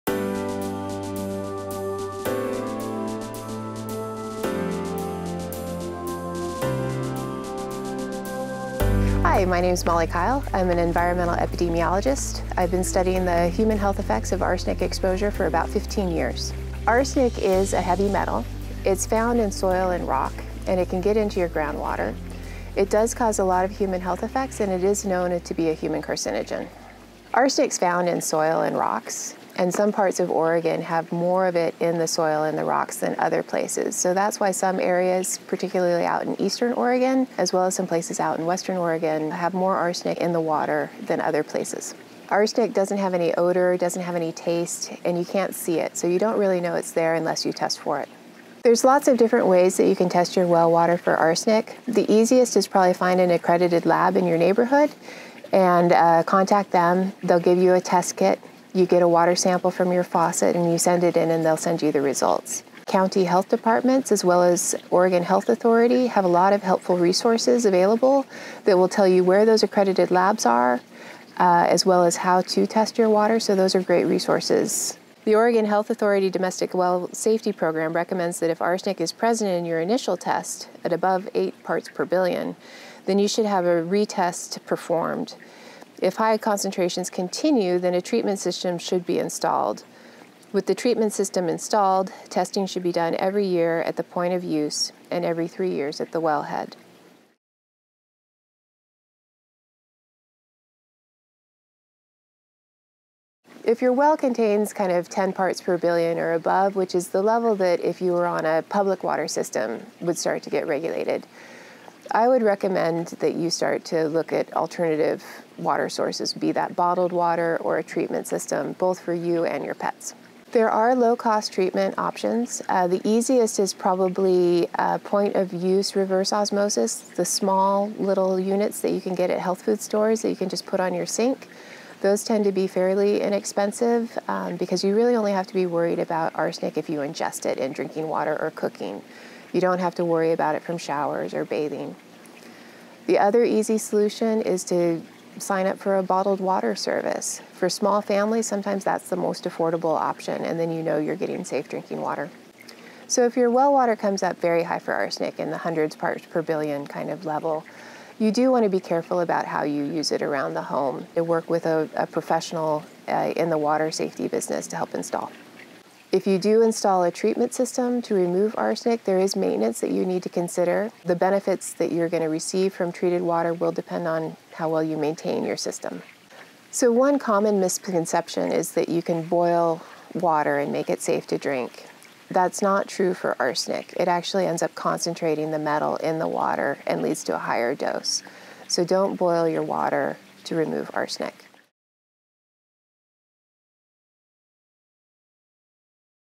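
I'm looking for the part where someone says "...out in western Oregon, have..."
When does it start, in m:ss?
0:38.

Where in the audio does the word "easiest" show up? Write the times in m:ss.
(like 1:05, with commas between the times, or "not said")
0:52, 2:03.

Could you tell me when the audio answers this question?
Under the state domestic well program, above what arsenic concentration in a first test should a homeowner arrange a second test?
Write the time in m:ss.
1:21.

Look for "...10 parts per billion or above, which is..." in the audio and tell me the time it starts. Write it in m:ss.
1:45.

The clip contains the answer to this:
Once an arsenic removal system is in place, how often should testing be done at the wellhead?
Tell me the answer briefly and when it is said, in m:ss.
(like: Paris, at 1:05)
every three years, at 1:35.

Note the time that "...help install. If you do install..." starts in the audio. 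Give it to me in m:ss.
2:44.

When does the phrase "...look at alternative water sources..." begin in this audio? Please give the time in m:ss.
1:54.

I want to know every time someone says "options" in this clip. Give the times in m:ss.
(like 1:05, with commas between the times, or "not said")
2:01, 2:29.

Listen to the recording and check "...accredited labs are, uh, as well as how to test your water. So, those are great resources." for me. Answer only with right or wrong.
right.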